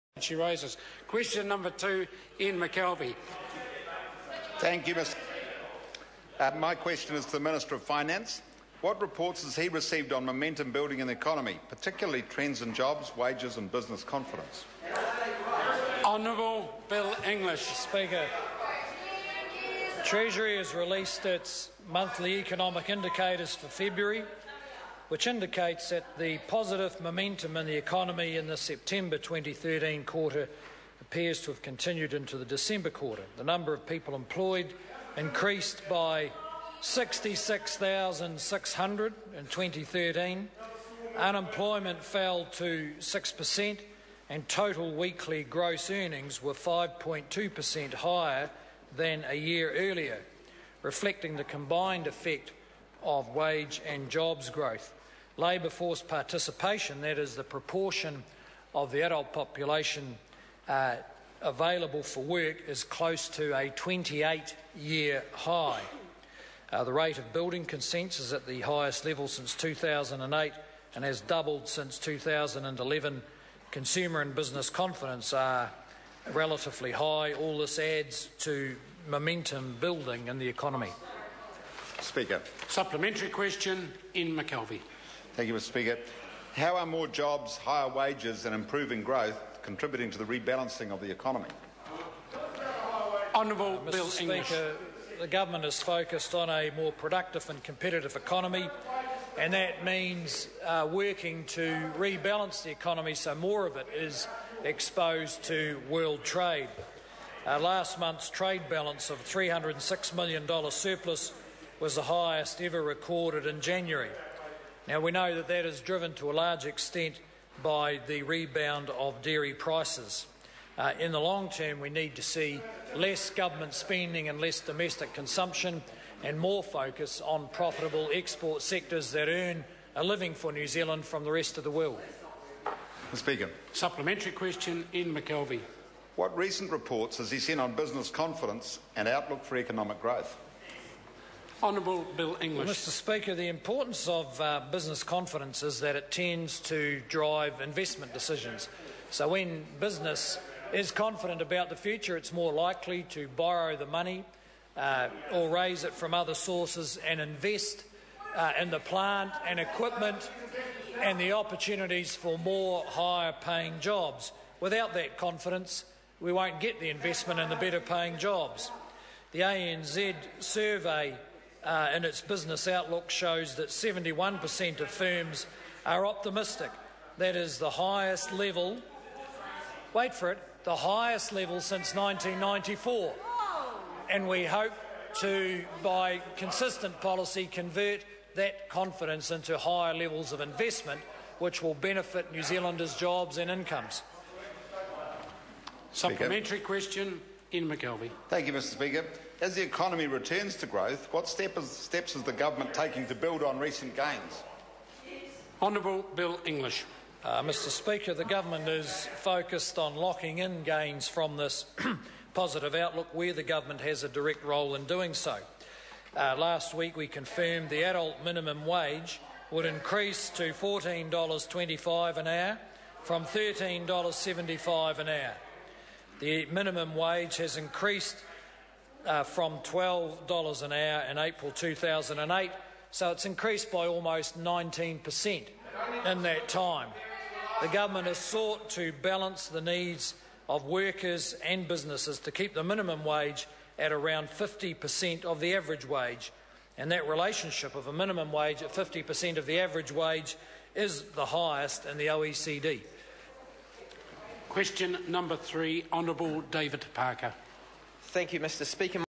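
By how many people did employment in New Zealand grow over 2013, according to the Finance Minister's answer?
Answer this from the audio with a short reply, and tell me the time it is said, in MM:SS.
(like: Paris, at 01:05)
66,600, at 00:36.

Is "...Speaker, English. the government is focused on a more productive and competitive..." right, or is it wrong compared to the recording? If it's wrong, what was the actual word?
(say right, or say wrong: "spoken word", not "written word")
right.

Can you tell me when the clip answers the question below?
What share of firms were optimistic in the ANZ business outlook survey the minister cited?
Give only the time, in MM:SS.
02:53.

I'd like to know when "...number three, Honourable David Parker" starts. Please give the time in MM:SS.
04:15.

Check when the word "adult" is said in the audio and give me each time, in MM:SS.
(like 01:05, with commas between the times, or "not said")
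00:59, 03:37.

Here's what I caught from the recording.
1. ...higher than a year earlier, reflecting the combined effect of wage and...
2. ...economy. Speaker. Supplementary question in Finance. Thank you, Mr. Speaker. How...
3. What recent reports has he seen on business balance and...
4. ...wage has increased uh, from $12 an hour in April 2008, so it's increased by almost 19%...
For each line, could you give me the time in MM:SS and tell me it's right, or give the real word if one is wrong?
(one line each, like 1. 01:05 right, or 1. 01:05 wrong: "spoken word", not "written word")
1. 00:47 right
2. 01:20 wrong: "McKelvie", not "Finance"
3. 02:16 wrong: "confidence", not "balance"
4. 03:46 right.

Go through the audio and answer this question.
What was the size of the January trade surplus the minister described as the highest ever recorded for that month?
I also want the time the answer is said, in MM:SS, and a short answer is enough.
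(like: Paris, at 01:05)
$306 million, at 01:49.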